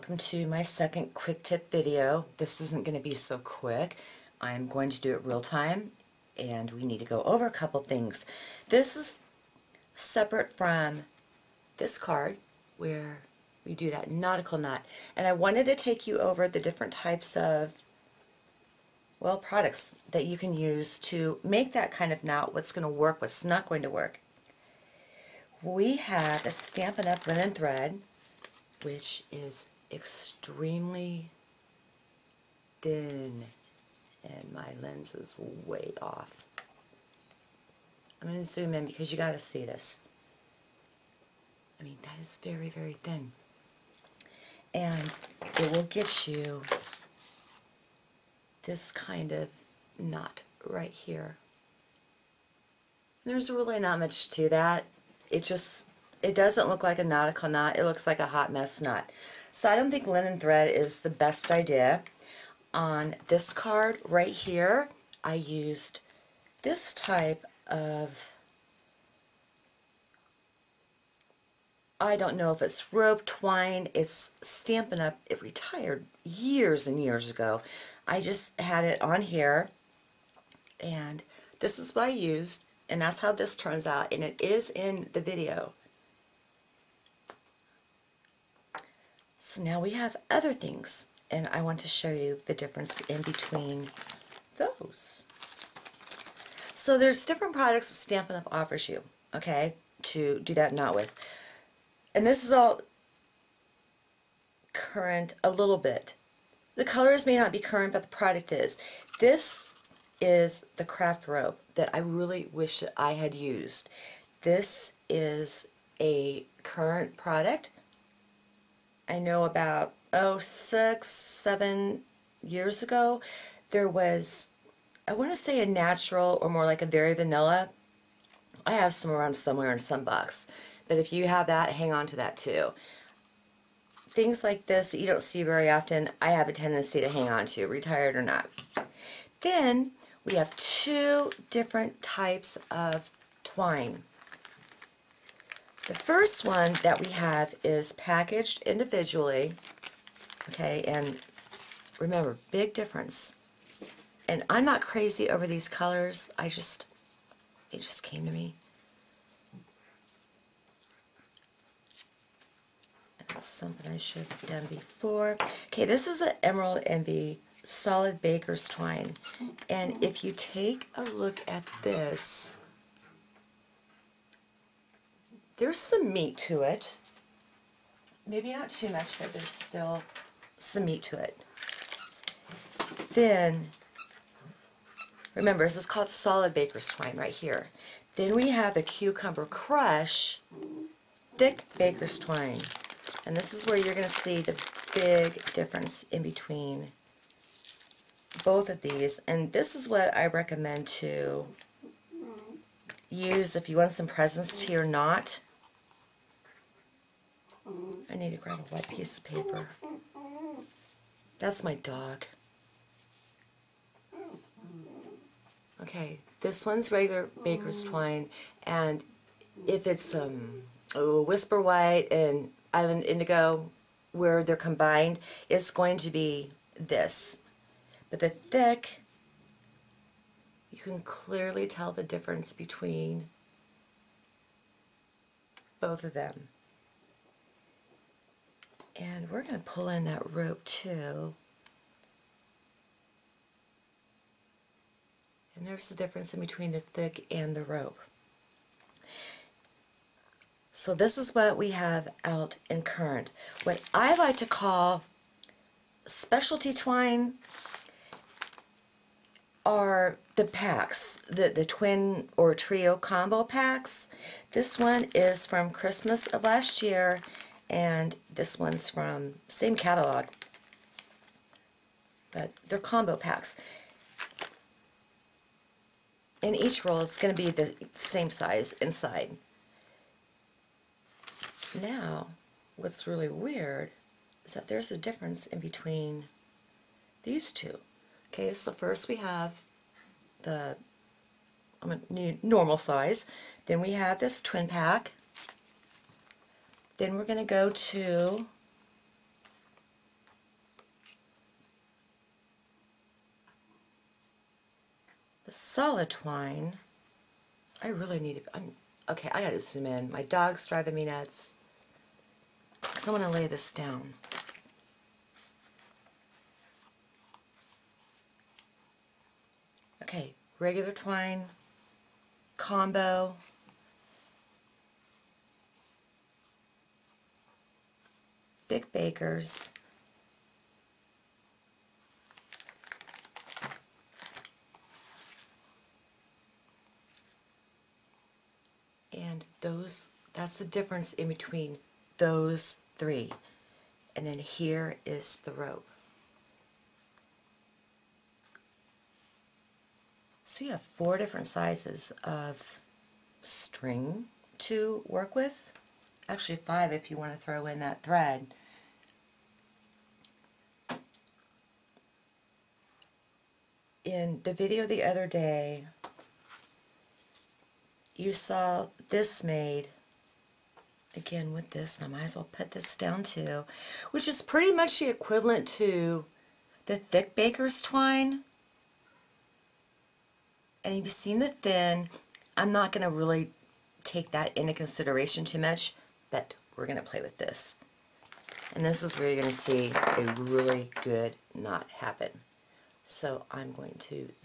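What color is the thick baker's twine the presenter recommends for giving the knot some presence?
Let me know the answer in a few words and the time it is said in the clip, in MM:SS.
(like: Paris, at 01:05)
Cucumber Crush, at 03:08.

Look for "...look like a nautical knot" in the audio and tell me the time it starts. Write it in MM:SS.
00:56.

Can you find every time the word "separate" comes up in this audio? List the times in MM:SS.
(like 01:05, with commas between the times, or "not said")
00:09.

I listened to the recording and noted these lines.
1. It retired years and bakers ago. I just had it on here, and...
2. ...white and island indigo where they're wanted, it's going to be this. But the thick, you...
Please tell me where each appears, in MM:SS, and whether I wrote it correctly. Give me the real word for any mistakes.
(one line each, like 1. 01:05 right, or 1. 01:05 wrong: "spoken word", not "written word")
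1. 01:15 wrong: "years", not "bakers"
2. 03:41 wrong: "combined", not "wanted".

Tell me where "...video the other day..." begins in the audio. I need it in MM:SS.
06:04.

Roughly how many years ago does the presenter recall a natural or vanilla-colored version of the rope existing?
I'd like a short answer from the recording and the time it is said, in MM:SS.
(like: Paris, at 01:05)
6 or 7 years, at 02:00.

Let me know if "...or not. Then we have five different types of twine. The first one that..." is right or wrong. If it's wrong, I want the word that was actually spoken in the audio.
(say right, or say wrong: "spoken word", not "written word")
wrong: "two", not "five".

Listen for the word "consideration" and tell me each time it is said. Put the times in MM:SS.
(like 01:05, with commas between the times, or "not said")
06:24.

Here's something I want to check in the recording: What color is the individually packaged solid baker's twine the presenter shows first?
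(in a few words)
Emerald Envy.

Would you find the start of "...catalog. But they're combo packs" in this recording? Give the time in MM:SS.
04:29.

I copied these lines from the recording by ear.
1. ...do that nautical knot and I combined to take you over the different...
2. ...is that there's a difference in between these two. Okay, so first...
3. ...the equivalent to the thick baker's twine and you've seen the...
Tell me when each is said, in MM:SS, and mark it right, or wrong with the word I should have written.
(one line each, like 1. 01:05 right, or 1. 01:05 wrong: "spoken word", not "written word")
1. 00:13 wrong: "wanted", not "combined"
2. 04:44 right
3. 06:14 right.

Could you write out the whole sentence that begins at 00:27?
Linen Thread, which is extremely thin, and my lens is way off.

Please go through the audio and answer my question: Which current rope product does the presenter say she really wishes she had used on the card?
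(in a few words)
Kraft rope.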